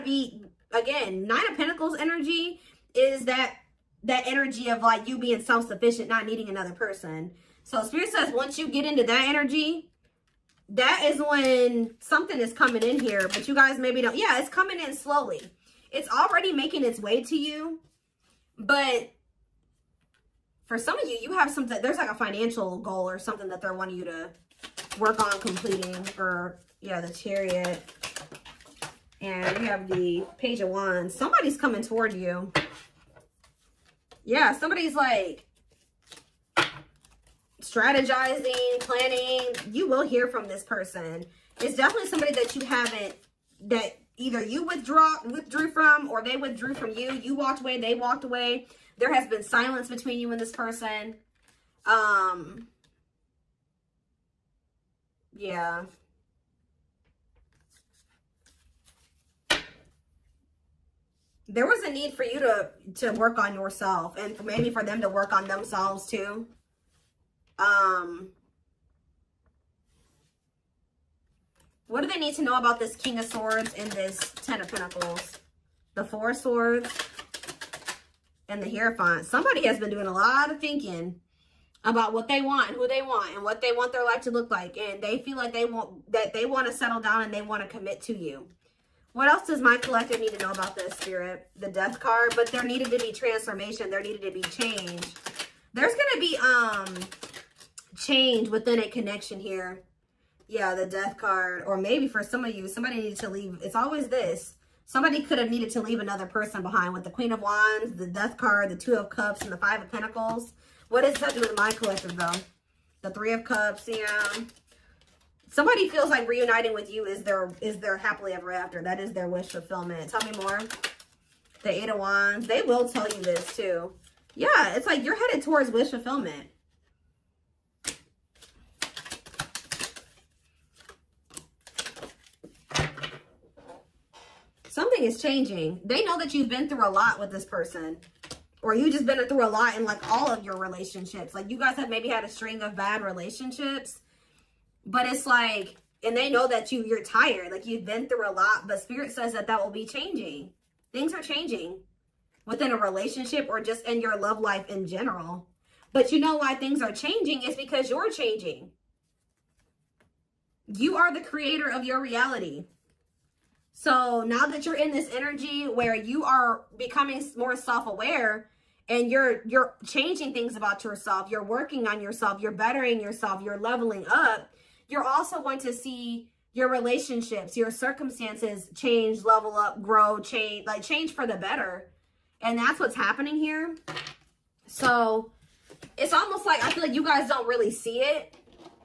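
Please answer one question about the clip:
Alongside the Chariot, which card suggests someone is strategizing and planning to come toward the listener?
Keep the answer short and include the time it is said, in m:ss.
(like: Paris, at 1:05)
Page of Wands, at 0:30.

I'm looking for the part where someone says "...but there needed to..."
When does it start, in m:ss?
1:32.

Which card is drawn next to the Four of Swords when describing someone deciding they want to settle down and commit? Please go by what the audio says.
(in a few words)
Hierophant.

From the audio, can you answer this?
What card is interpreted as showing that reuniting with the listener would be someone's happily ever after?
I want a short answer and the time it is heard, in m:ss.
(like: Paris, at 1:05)
Three of Cups, at 1:53.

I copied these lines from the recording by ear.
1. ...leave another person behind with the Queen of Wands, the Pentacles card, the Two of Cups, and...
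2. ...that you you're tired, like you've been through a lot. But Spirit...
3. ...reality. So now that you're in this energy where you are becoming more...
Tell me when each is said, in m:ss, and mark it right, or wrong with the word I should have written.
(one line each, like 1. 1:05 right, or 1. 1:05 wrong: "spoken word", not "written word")
1. 1:45 wrong: "Death", not "Pentacles"
2. 2:26 right
3. 2:42 right.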